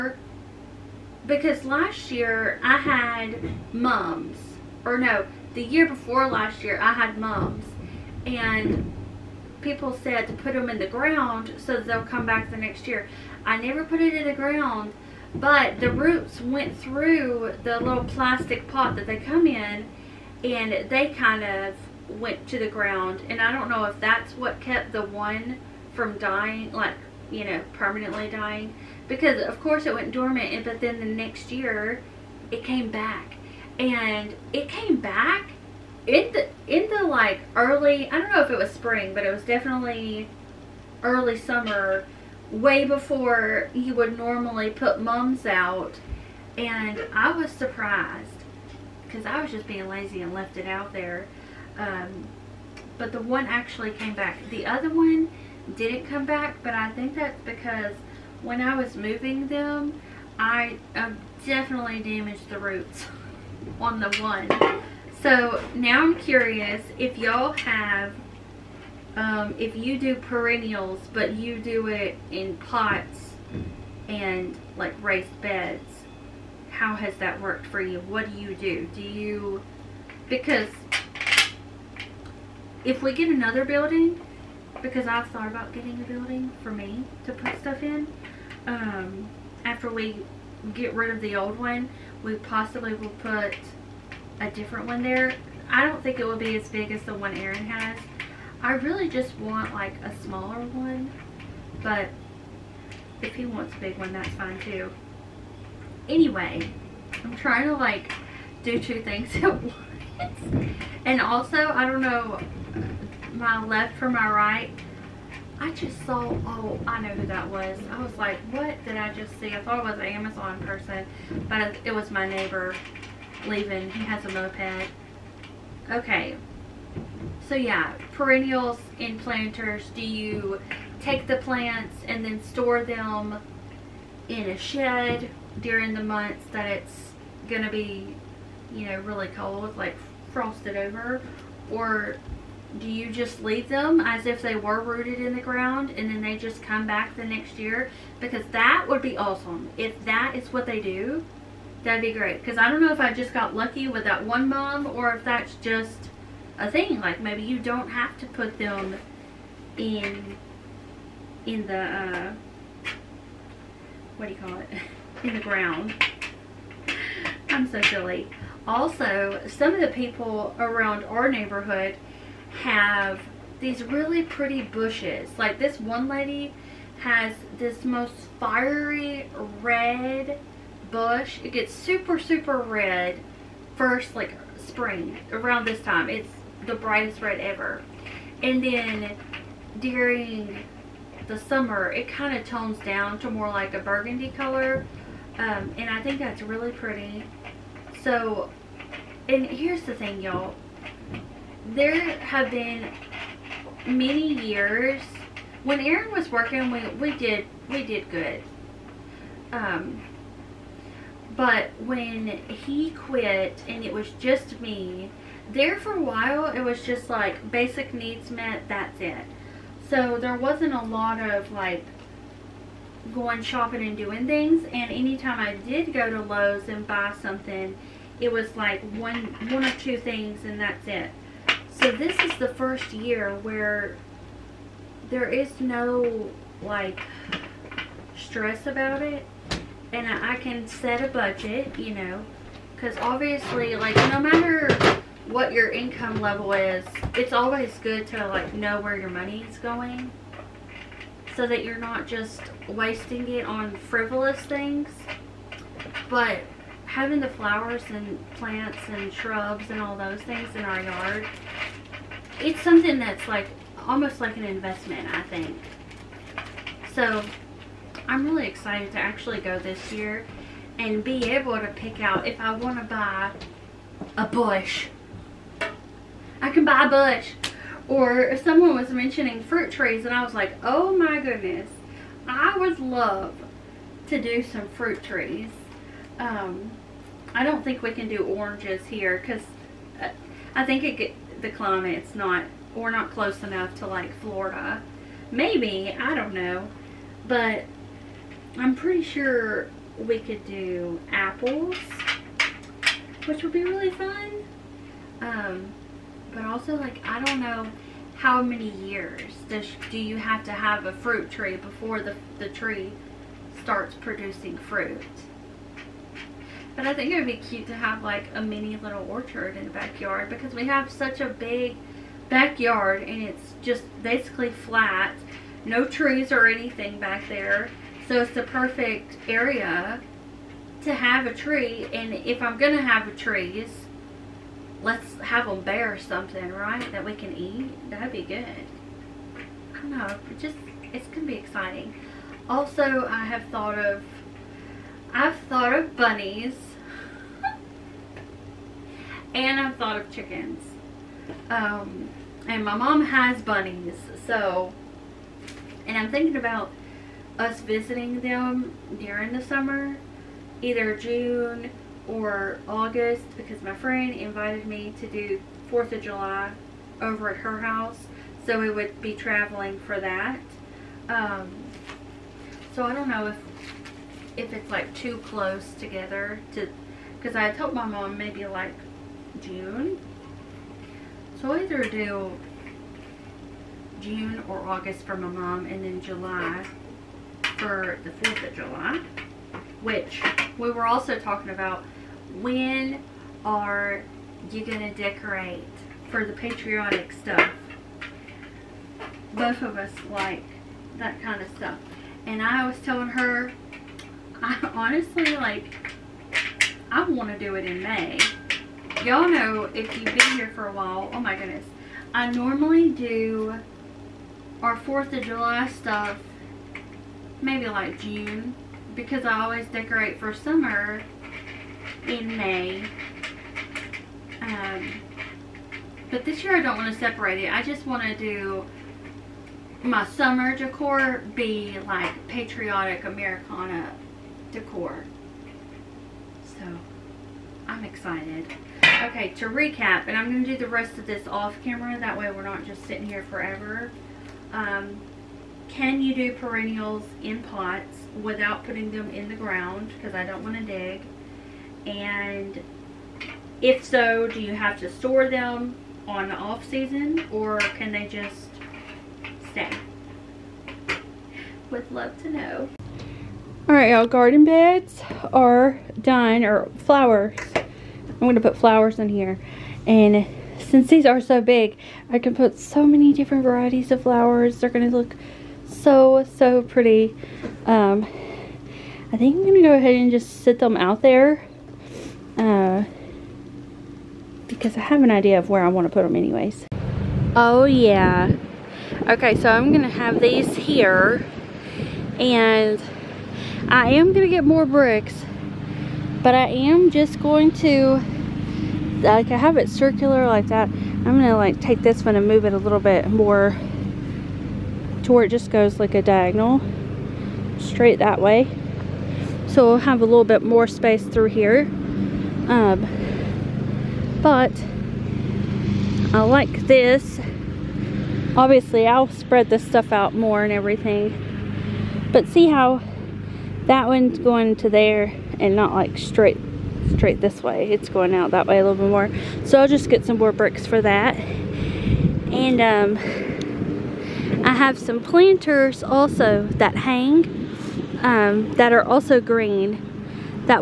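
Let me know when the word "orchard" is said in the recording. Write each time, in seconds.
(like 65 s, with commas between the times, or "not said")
319 s.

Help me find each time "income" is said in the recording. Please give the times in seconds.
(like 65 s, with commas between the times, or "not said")
245 s.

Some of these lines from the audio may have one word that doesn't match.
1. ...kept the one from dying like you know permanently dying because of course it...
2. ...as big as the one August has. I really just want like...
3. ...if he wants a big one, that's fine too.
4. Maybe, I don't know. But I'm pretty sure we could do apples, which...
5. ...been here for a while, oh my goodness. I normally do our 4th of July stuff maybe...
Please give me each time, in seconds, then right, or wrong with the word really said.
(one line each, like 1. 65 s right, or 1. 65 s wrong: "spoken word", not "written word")
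1. 24 s right
2. 96 s wrong: "Aaron", not "August"
3. 103 s right
4. 295 s right
5. 410 s right.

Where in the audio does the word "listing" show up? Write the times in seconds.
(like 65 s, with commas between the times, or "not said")
not said.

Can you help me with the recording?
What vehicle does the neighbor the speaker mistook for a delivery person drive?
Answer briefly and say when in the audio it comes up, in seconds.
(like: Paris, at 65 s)
Moped, at 124 s.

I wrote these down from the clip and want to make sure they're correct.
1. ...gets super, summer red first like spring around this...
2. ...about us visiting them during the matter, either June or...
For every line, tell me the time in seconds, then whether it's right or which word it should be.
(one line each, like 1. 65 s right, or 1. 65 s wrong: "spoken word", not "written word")
1. 181 s wrong: "super", not "summer"
2. 356 s wrong: "summer", not "matter".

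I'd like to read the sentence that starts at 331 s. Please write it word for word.
And if I'm going to have a trees, let's have them bear something, right, that we can eat.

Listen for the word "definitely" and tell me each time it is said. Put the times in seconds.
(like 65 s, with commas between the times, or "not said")
39 s, 61 s.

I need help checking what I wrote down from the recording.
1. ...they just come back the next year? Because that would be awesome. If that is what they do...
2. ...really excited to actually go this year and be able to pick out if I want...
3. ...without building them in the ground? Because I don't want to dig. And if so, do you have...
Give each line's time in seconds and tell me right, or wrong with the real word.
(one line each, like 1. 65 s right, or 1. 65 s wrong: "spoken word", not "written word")
1. 146 s right
2. 268 s right
3. 448 s wrong: "putting", not "building".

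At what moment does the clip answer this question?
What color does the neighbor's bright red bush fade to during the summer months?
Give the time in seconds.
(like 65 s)
193 s.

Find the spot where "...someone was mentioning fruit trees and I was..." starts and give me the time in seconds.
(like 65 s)
278 s.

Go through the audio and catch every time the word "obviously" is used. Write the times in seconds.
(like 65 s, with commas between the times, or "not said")
242 s, 518 s.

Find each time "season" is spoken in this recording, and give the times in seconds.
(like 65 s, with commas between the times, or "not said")
456 s.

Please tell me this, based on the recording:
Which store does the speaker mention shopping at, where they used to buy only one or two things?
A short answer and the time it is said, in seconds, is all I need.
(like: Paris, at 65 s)
Lowe's, at 226 s.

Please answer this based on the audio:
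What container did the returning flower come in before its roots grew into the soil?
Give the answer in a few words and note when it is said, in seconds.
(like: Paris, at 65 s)
Little plastic pot, at 17 s.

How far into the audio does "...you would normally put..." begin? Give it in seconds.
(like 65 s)
43 s.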